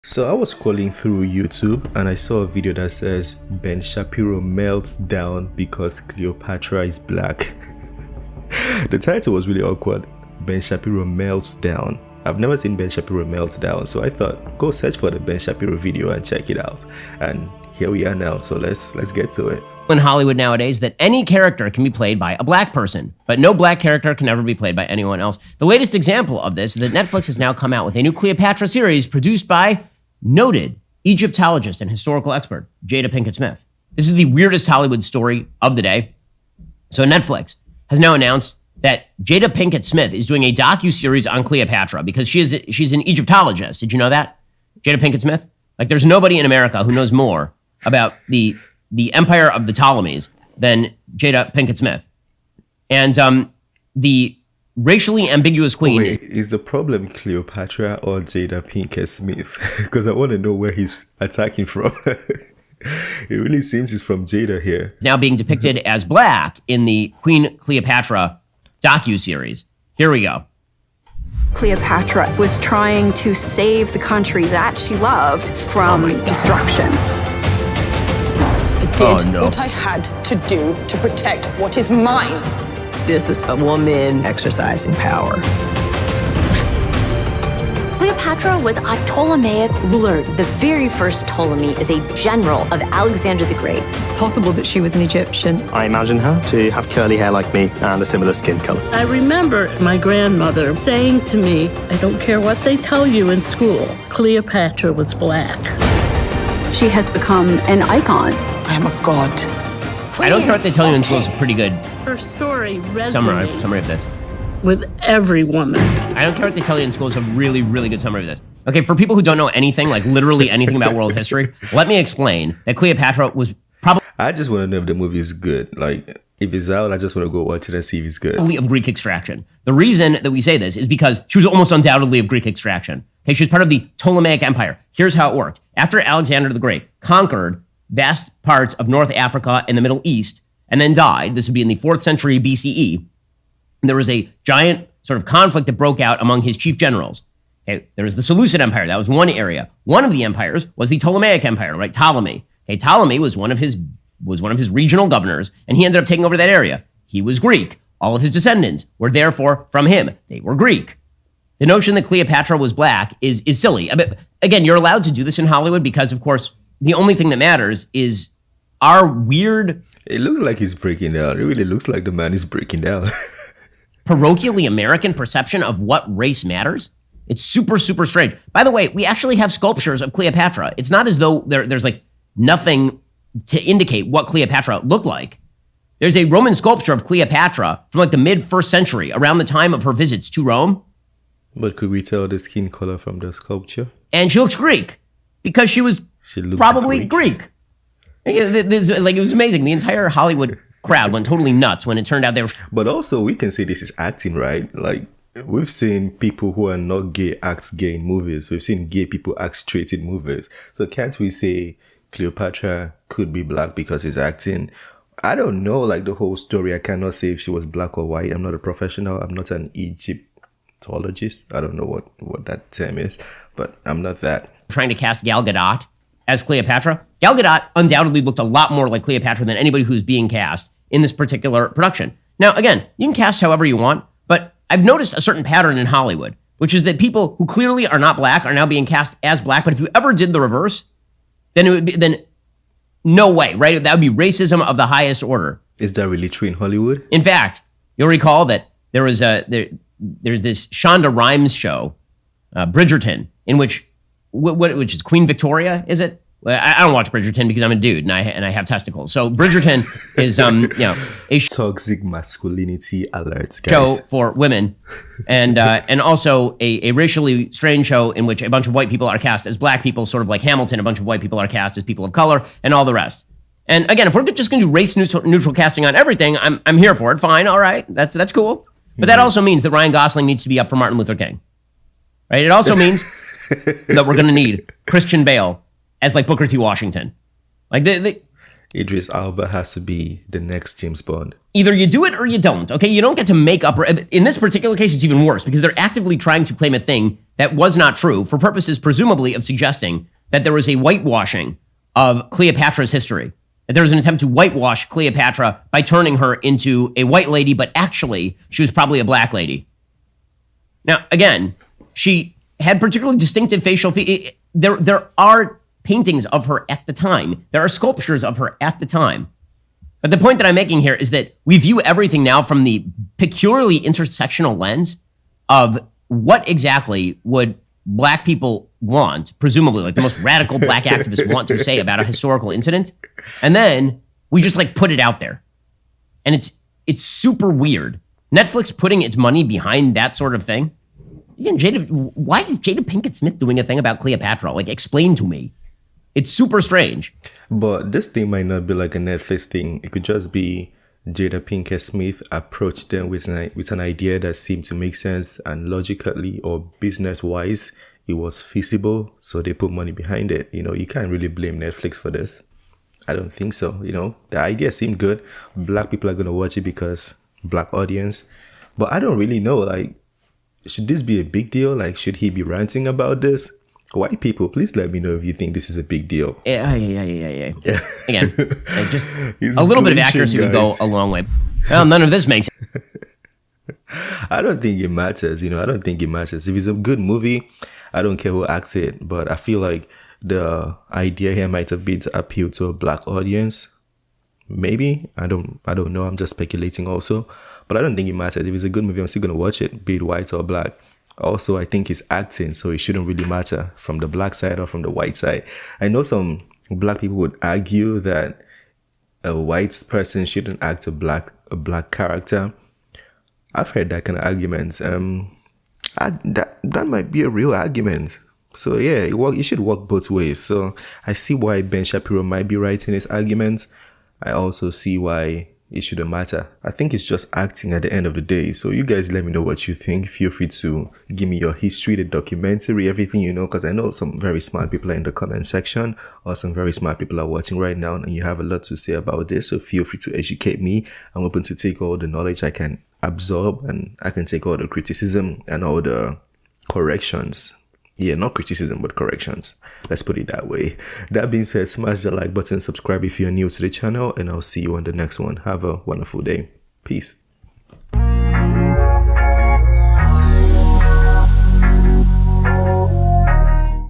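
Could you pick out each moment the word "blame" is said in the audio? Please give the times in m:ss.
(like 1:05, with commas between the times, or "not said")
6:01.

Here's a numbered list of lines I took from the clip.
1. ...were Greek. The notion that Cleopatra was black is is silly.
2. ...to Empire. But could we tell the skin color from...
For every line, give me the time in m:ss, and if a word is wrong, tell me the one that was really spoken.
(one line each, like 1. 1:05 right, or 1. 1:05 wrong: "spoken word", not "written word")
1. 2:40 right
2. 3:10 wrong: "Rome", not "Empire".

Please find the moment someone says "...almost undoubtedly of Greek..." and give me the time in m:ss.
2:11.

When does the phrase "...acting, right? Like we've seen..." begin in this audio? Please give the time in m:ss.
3:23.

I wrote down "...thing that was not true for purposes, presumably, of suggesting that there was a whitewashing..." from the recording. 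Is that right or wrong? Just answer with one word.
right.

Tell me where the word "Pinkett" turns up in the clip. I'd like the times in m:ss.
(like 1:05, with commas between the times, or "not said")
0:33, 0:39, 0:44, 0:51, 0:58, 5:42, 5:51.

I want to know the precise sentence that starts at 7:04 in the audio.
I also see why it shouldn't matter.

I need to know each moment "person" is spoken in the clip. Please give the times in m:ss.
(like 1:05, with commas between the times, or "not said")
0:22, 6:49.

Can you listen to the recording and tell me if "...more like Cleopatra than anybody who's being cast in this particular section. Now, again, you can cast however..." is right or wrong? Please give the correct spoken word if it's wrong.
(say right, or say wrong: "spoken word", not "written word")
wrong: "production", not "section".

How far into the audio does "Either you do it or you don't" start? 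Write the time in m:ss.
4:51.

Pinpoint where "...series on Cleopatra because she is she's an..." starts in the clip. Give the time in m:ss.
0:40.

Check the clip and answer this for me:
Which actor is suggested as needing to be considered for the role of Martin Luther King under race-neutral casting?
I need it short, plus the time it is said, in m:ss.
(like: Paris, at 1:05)
Ryan Gosling, at 4:39.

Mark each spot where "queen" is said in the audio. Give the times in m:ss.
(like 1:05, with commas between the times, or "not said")
0:55, 1:07, 4:15.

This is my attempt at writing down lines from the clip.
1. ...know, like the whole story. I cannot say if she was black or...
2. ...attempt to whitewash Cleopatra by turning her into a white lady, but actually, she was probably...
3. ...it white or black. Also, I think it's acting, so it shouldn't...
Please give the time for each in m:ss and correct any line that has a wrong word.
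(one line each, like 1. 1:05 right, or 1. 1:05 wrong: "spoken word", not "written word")
1. 3:35 right
2. 5:03 right
3. 6:39 right.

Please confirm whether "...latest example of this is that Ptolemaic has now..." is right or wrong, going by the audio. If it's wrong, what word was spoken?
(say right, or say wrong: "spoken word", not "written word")
wrong: "Netflix", not "Ptolemaic".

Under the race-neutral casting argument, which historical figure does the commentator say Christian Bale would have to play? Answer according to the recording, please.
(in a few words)
Booker T. Washington.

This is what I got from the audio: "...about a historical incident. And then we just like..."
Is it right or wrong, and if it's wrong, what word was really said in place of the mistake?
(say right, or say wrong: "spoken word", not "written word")
right.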